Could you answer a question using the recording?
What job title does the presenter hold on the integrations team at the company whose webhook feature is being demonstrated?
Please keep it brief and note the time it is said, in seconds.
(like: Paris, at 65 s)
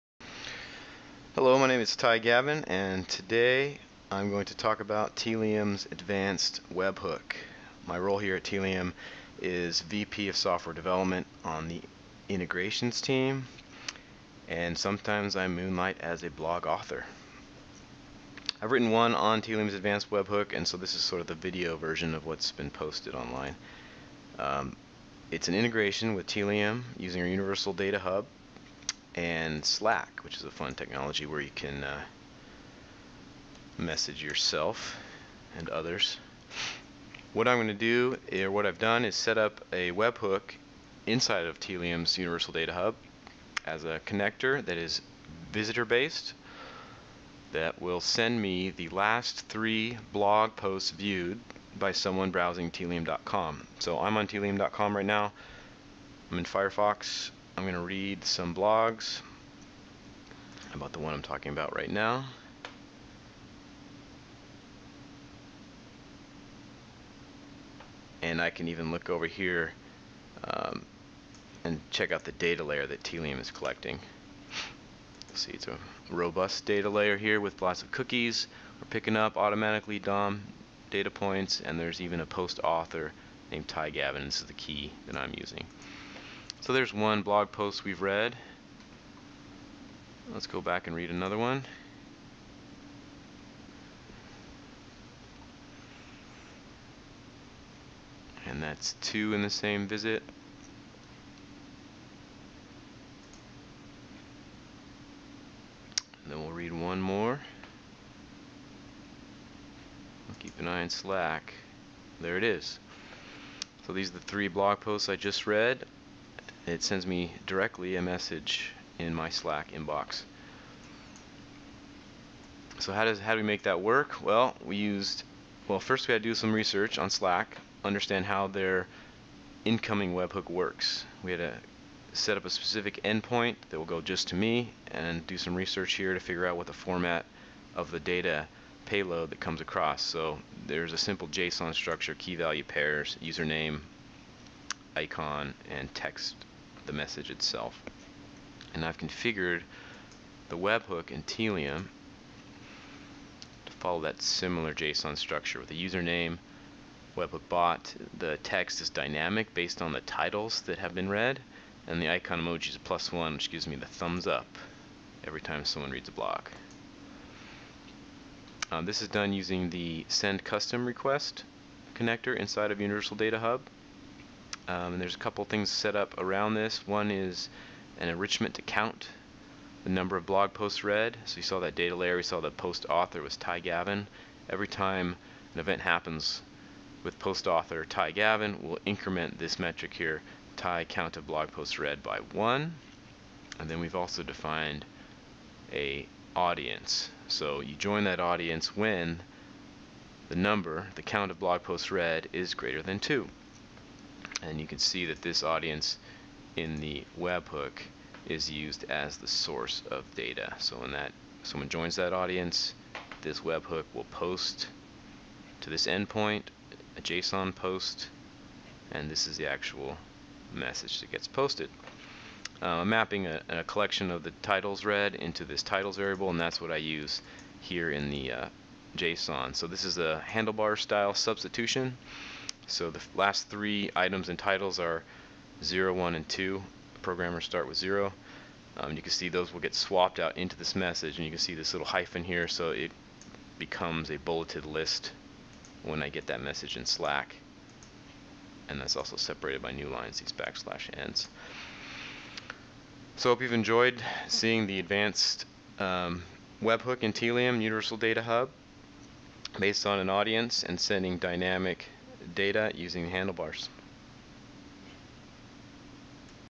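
VP of Software Development, at 9 s.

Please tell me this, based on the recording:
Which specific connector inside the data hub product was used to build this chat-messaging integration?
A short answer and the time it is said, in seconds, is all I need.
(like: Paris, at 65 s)
send custom request, at 170 s.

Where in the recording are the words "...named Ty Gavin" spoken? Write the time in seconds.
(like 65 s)
83 s.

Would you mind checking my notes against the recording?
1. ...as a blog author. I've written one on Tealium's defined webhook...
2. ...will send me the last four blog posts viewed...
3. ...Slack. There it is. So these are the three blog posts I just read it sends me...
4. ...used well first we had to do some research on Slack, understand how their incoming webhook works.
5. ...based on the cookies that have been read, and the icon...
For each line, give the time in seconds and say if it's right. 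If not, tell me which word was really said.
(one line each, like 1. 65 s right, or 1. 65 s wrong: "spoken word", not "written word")
1. 16 s wrong: "advanced", not "defined"
2. 47 s wrong: "three", not "four"
3. 110 s right
4. 124 s right
5. 159 s wrong: "titles", not "cookies".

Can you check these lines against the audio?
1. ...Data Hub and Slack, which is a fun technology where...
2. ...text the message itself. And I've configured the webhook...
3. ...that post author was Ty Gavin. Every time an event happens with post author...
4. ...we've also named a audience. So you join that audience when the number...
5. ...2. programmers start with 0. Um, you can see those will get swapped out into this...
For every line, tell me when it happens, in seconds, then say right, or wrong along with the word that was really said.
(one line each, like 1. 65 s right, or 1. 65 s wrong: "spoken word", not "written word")
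1. 27 s right
2. 145 s right
3. 182 s right
4. 193 s wrong: "defined", not "named"
5. 236 s right.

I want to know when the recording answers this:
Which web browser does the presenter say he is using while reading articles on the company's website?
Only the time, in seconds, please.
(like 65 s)
56 s.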